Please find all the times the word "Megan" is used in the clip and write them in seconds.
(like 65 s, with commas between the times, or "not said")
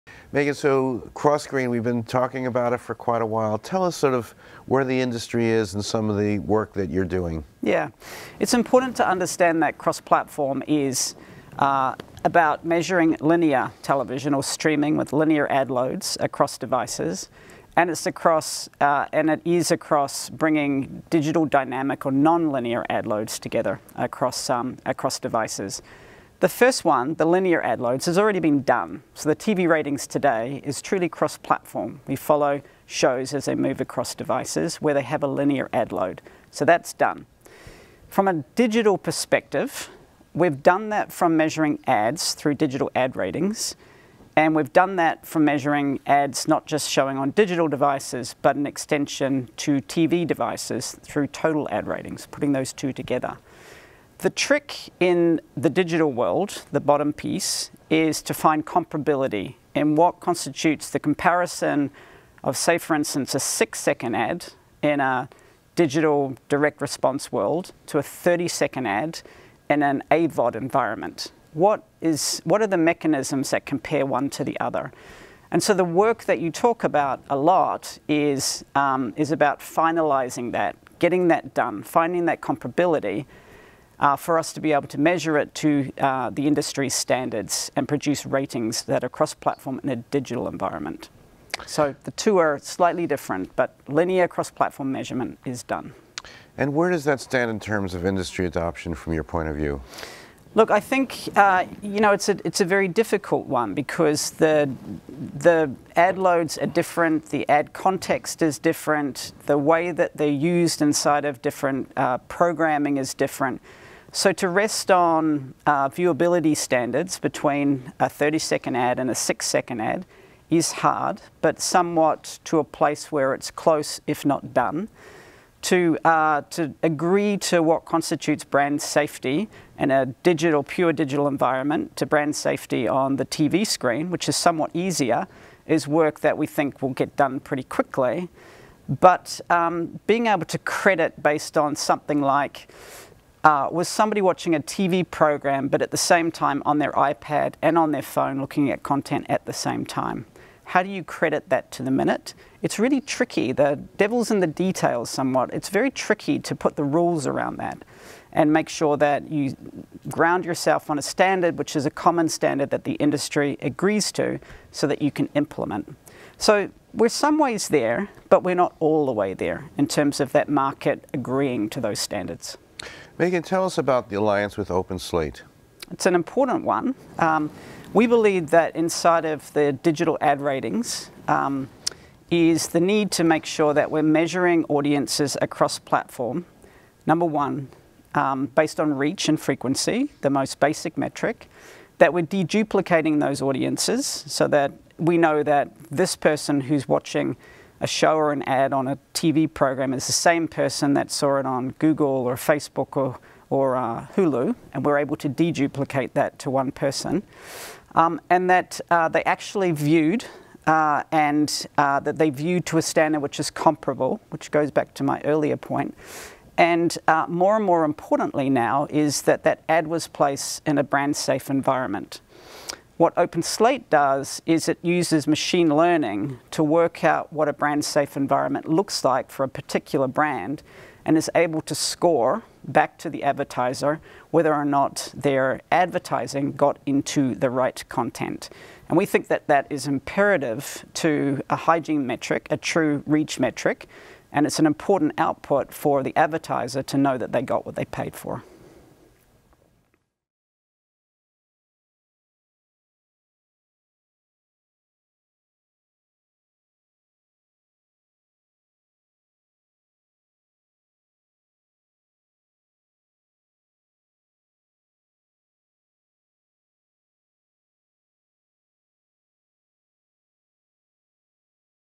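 0 s, 173 s.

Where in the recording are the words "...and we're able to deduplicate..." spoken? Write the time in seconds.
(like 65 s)
204 s.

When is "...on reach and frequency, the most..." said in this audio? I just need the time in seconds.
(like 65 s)
188 s.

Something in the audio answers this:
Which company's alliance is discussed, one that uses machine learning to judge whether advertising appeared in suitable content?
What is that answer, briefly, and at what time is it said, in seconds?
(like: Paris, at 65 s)
OpenSlate, at 174 s.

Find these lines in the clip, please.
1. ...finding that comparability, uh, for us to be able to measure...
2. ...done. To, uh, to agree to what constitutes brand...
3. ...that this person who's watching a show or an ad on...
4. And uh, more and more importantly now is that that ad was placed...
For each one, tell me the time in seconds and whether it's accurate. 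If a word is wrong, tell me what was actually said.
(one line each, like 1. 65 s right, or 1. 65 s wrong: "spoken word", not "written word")
1. 81 s right
2. 124 s right
3. 195 s right
4. 216 s right.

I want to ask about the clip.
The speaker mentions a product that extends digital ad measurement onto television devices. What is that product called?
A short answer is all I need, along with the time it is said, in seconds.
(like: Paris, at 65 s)
total ad ratings, at 51 s.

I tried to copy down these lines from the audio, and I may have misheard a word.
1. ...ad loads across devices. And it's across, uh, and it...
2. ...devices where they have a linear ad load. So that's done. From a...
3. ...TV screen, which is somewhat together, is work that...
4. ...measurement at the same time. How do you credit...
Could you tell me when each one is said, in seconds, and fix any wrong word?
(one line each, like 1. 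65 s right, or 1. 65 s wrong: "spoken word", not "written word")
1. 15 s right
2. 34 s right
3. 133 s wrong: "easier", not "together"
4. 148 s wrong: "content", not "measurement".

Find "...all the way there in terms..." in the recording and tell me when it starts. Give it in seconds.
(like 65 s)
168 s.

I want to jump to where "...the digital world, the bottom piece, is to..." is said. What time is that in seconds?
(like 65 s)
55 s.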